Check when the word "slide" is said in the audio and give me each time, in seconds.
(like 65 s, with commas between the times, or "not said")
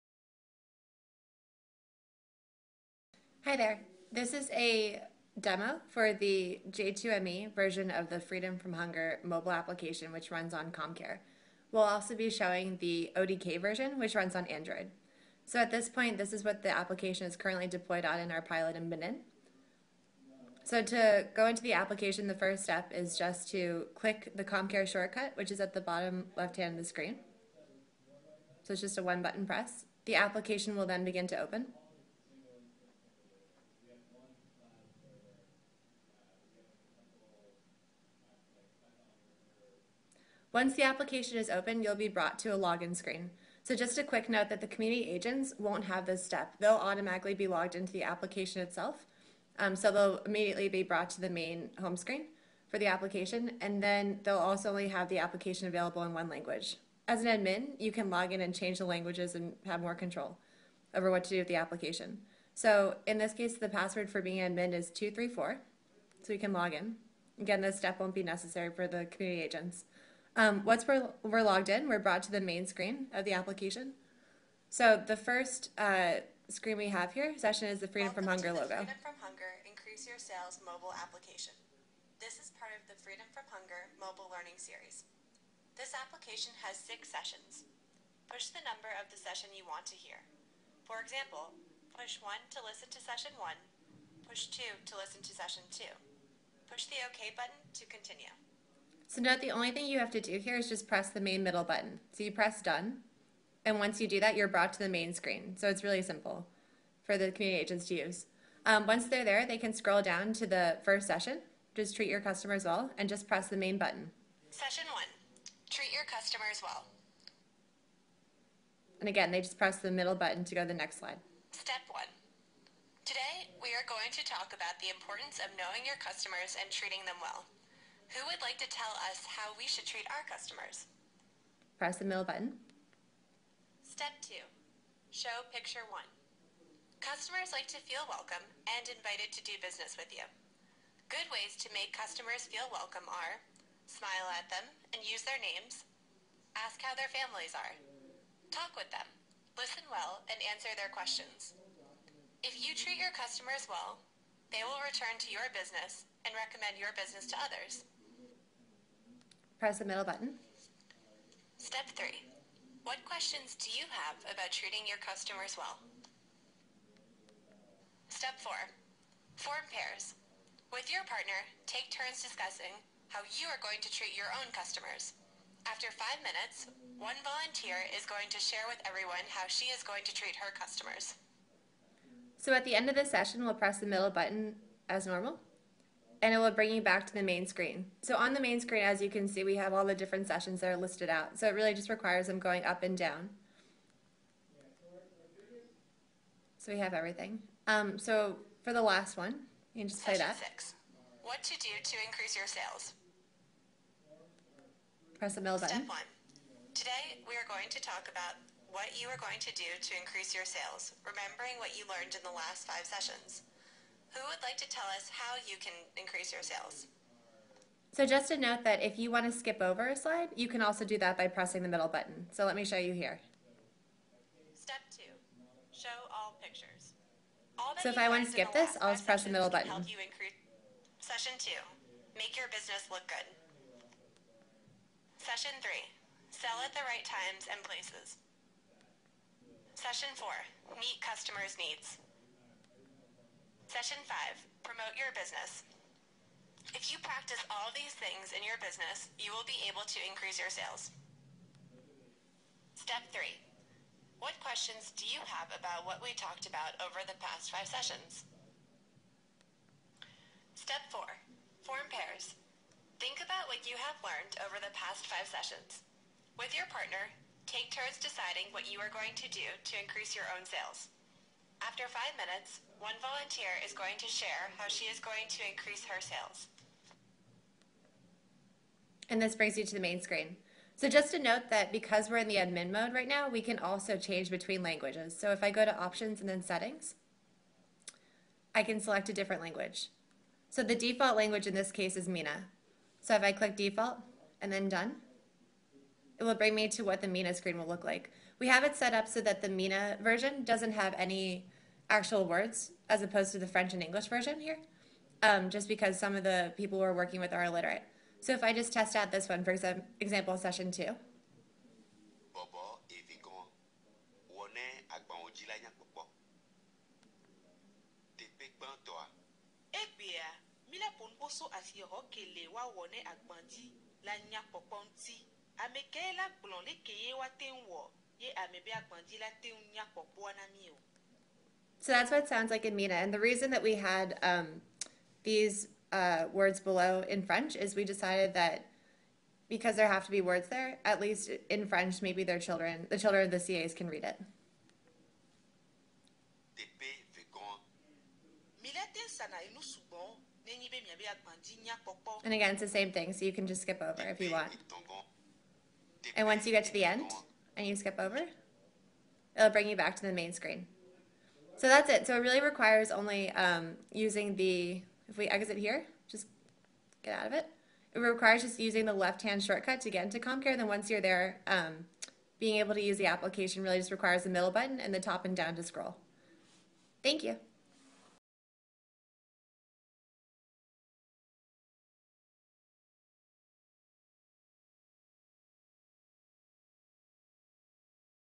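120 s, 219 s.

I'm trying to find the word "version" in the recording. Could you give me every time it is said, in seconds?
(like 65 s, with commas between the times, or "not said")
7 s, 13 s, 300 s, 304 s.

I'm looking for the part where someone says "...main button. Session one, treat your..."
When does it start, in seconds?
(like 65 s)
113 s.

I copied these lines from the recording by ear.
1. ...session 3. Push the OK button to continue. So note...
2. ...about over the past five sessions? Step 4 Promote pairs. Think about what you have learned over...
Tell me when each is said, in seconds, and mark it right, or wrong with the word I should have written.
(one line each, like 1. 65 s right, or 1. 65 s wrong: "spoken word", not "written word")
1. 95 s wrong: "2", not "3"
2. 256 s wrong: "Form", not "Promote".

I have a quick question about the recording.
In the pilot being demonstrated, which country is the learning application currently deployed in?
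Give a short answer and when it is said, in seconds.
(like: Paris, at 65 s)
Benin, at 18 s.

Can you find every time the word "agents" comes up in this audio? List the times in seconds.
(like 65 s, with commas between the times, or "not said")
45 s, 69 s, 107 s.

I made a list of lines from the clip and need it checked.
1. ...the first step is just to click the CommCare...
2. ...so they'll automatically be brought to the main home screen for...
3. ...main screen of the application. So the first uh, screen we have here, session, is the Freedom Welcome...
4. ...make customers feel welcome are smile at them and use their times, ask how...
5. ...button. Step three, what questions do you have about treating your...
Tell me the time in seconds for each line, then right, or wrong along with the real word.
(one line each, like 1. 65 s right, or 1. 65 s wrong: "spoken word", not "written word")
1. 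22 s right
2. 49 s wrong: "immediately", not "automatically"
3. 72 s right
4. 141 s wrong: "names", not "times"
5. 160 s right.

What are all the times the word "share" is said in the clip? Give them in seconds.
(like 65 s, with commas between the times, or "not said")
178 s, 274 s.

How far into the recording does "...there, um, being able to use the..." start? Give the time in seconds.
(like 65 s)
371 s.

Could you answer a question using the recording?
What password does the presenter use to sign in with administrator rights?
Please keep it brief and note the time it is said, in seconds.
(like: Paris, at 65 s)
234, at 64 s.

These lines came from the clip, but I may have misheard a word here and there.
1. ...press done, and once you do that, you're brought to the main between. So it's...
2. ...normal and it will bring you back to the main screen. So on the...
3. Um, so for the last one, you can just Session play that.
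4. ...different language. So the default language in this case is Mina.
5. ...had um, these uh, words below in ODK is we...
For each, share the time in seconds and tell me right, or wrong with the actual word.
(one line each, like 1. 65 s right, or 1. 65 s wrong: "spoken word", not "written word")
1. 102 s wrong: "screen", not "between"
2. 185 s right
3. 197 s right
4. 289 s right
5. 333 s wrong: "French", not "ODK".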